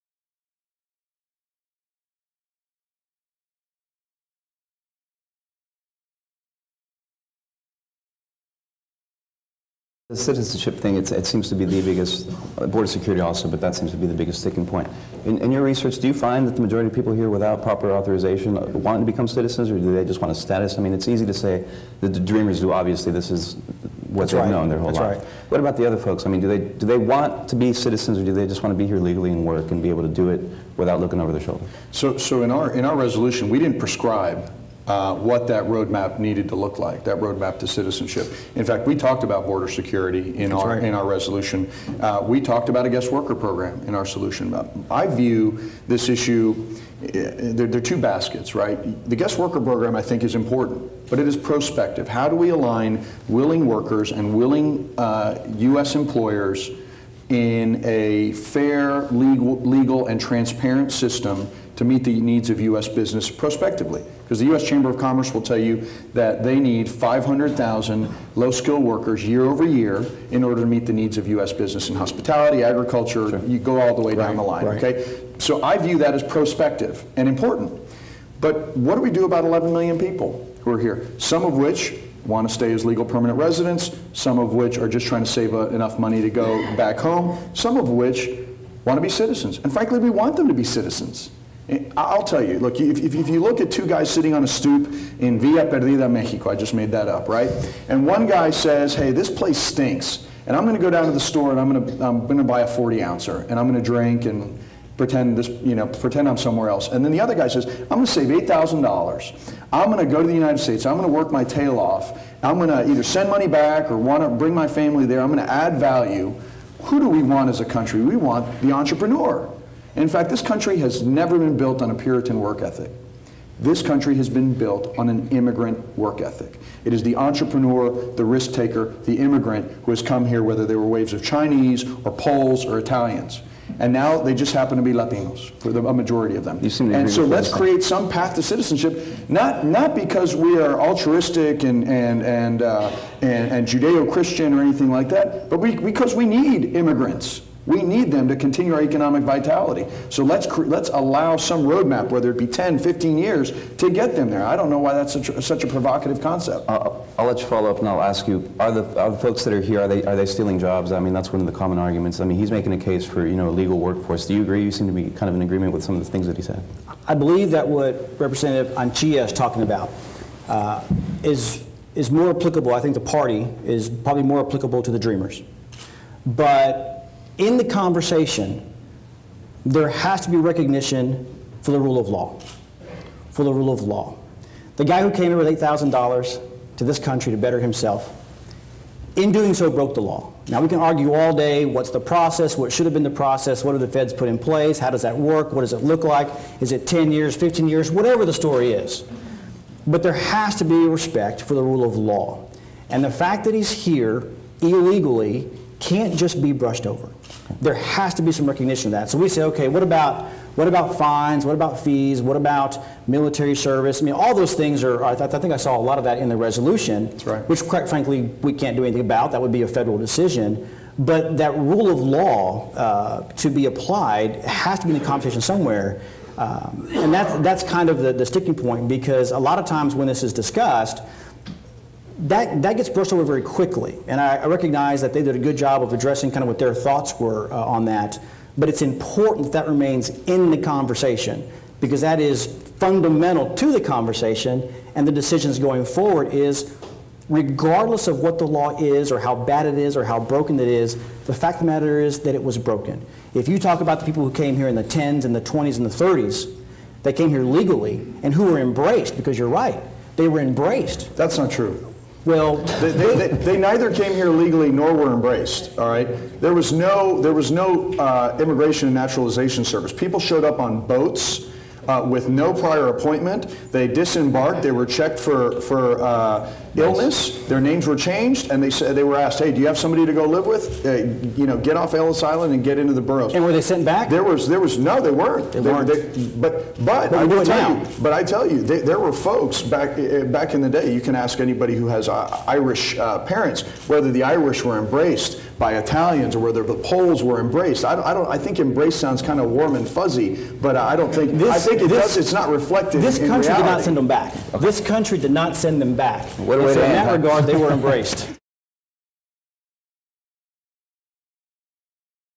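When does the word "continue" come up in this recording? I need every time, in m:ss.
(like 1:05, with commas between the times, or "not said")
2:28.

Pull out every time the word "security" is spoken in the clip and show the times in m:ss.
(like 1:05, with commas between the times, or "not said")
0:12, 0:39.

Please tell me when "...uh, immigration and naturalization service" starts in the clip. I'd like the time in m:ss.
4:27.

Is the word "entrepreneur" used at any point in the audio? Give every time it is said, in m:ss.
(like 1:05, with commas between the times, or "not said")
1:58, 2:07.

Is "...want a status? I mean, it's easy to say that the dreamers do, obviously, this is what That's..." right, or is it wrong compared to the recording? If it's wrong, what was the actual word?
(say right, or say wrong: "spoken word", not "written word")
right.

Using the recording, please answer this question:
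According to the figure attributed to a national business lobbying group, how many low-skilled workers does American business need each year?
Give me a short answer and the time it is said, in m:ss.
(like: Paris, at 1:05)
500,000, at 1:06.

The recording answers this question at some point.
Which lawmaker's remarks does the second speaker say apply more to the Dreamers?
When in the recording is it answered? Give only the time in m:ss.
2:48.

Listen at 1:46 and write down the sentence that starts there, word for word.
And then the other guy says, I'm going to save $8,000.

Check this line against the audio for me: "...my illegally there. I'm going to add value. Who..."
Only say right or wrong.
wrong.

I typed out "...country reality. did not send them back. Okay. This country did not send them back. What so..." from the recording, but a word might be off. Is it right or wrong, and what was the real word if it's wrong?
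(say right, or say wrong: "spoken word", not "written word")
right.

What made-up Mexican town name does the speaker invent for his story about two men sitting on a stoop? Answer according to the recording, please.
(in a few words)
Villa Perdida.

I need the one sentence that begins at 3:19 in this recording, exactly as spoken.
But there has to be respect for the rule of law.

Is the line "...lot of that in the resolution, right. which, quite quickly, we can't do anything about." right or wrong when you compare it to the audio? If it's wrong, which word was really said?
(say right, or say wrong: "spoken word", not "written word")
wrong: "frankly", not "quickly".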